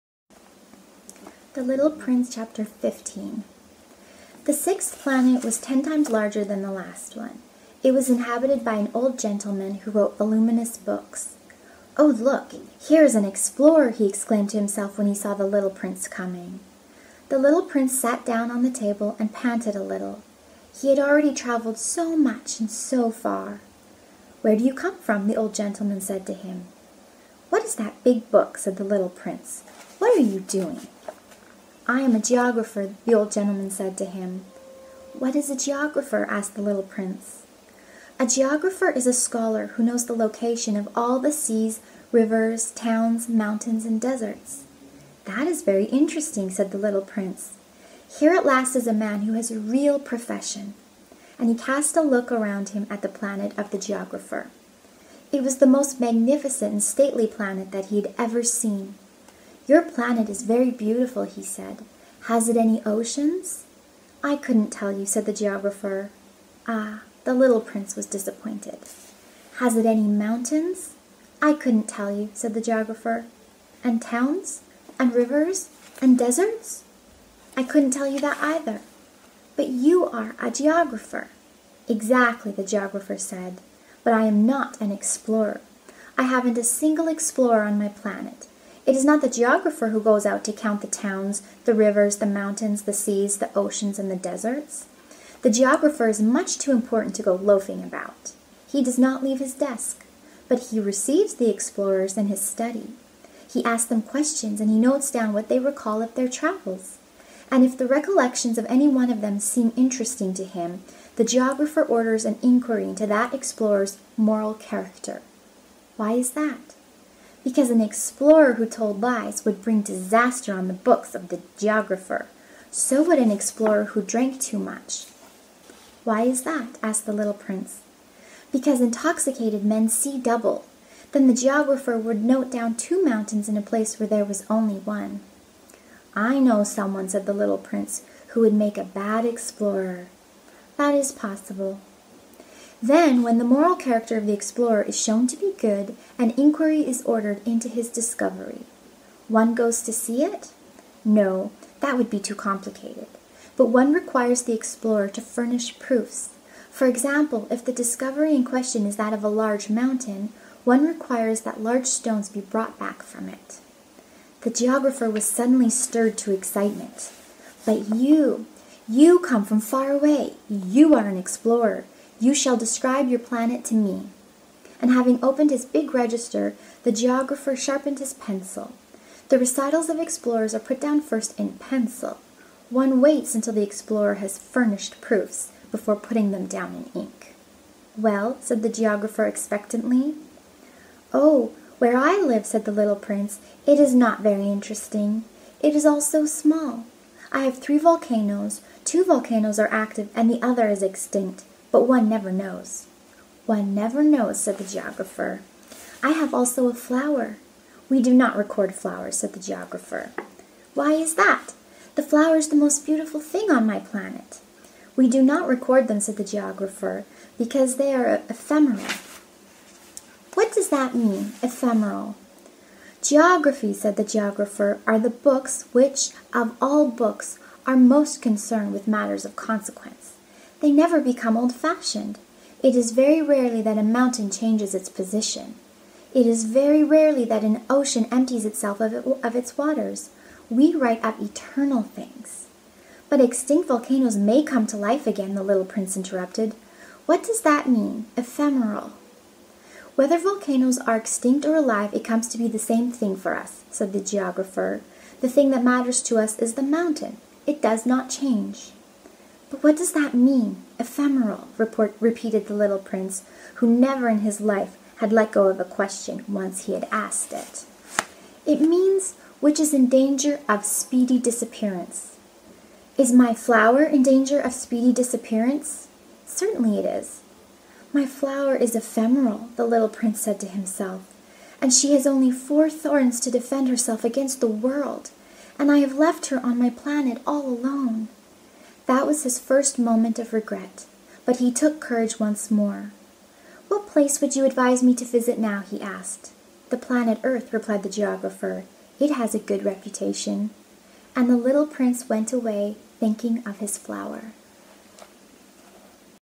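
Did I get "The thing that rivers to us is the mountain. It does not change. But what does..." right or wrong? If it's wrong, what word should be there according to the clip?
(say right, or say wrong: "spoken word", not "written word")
wrong: "matters", not "rivers".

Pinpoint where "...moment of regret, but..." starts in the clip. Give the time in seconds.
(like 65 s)
289 s.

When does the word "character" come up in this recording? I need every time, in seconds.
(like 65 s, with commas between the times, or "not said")
114 s, 143 s.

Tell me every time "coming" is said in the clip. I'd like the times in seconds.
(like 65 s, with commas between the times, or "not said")
16 s.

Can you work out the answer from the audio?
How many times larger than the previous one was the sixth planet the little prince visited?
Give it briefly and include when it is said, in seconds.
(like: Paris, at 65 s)
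10, at 5 s.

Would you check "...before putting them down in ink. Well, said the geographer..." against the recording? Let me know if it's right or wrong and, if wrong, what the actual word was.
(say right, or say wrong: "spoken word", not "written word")
right.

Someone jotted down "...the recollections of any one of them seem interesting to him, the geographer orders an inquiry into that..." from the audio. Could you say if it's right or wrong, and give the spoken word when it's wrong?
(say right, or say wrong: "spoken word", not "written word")
right.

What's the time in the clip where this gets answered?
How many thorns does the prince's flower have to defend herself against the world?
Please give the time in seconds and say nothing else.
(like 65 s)
282 s.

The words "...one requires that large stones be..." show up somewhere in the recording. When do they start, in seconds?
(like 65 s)
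160 s.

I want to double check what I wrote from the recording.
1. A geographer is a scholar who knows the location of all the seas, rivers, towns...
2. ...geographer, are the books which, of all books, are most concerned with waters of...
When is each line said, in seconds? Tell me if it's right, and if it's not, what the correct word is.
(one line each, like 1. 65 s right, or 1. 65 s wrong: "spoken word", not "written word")
1. 38 s right
2. 224 s wrong: "matters", not "waters".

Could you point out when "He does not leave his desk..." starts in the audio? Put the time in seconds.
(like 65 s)
98 s.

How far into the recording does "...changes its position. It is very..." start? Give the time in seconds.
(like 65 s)
234 s.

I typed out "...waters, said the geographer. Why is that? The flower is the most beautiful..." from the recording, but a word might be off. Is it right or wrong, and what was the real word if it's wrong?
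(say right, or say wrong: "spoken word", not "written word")
wrong: "flowers", not "waters".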